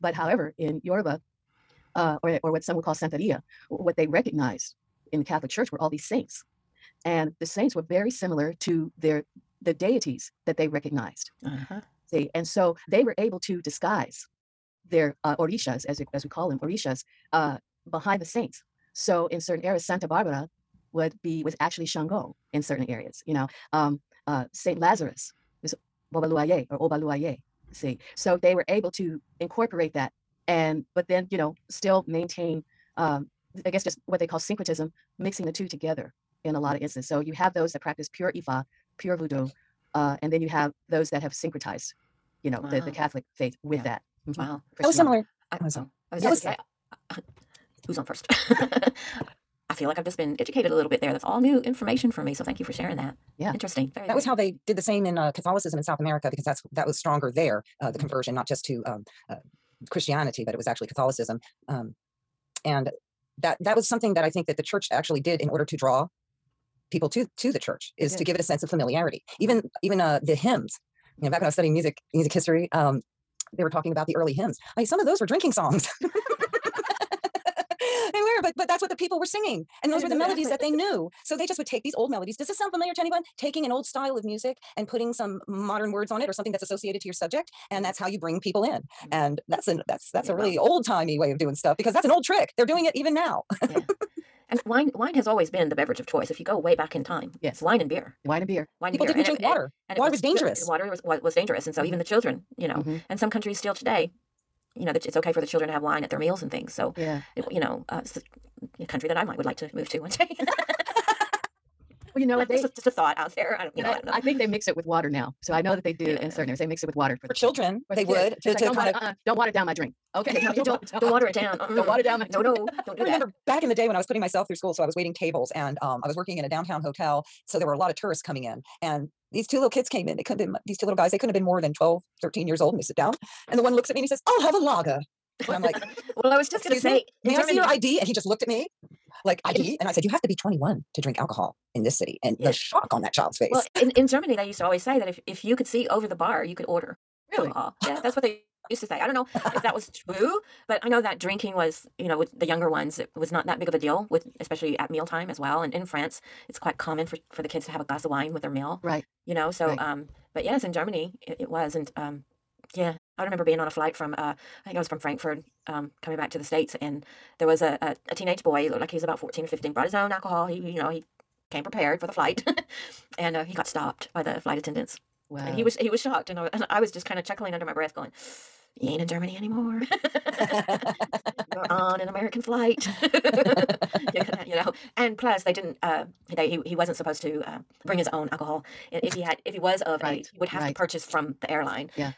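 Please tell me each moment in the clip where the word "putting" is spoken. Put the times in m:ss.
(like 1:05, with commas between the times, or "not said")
1:24, 2:04.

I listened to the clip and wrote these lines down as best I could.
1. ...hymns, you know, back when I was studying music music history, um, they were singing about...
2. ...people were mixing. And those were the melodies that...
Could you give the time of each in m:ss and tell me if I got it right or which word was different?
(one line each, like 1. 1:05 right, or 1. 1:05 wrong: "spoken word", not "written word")
1. 1:10 wrong: "talking", not "singing"
2. 1:18 wrong: "singing", not "mixing".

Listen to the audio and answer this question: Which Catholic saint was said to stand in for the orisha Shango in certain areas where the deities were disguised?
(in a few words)
Santa Barbara.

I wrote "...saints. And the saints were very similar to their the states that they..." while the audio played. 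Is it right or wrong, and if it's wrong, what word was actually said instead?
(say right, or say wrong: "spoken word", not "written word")
wrong: "deities", not "states".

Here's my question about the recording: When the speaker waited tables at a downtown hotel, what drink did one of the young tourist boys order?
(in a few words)
lager.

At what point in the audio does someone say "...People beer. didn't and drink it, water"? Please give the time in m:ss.
1:38.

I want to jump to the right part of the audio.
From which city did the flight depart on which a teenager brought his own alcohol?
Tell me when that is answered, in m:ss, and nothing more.
2:44.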